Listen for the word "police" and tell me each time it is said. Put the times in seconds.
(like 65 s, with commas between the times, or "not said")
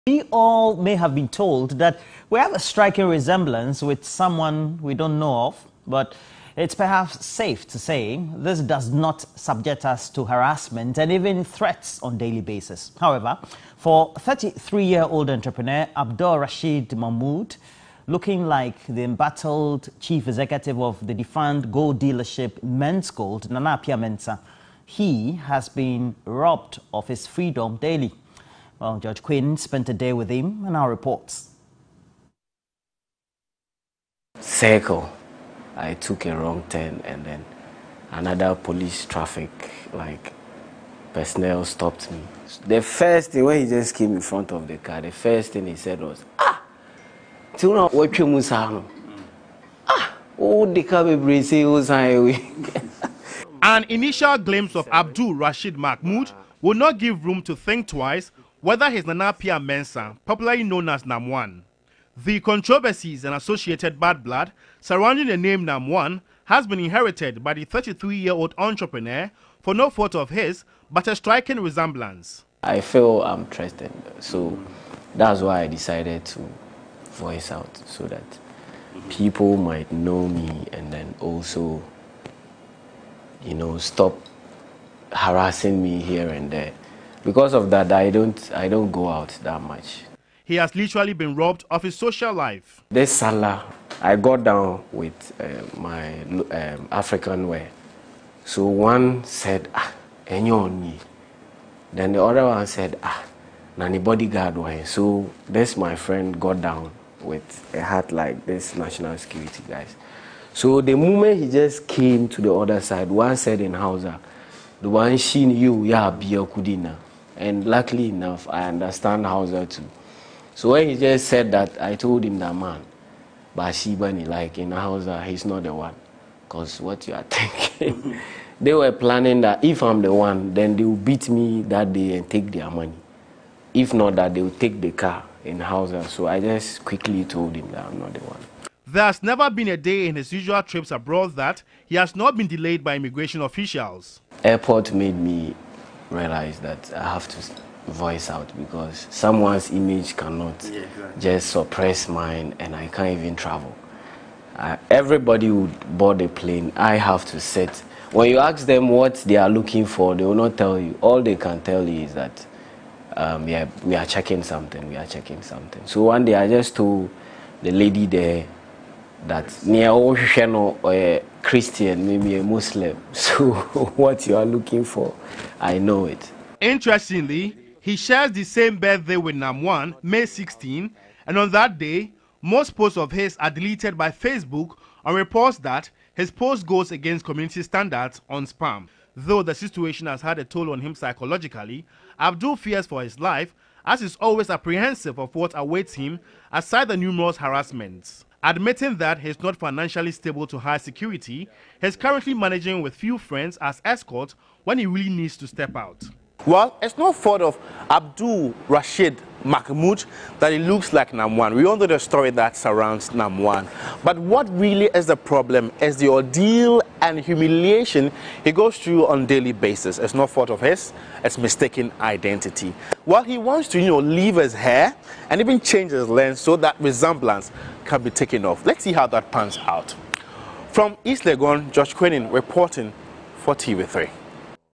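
38 s.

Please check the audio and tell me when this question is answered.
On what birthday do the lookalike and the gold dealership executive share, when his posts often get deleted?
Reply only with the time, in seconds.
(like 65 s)
180 s.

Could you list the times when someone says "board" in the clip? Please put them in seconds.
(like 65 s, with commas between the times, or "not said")
155 s.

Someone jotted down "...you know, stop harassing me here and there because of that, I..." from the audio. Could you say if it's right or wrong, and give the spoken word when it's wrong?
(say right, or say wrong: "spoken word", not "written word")
right.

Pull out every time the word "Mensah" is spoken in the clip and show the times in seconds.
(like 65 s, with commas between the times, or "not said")
23 s, 59 s.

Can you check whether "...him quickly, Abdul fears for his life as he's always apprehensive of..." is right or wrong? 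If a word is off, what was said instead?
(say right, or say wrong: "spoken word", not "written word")
wrong: "psychologically", not "quickly".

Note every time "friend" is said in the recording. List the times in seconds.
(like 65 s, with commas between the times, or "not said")
105 s, 203 s.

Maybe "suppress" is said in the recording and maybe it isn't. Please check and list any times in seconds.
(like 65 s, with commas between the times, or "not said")
151 s.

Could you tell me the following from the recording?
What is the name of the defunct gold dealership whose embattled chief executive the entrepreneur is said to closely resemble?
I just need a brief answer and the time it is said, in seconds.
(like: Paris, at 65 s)
Menzgold, at 22 s.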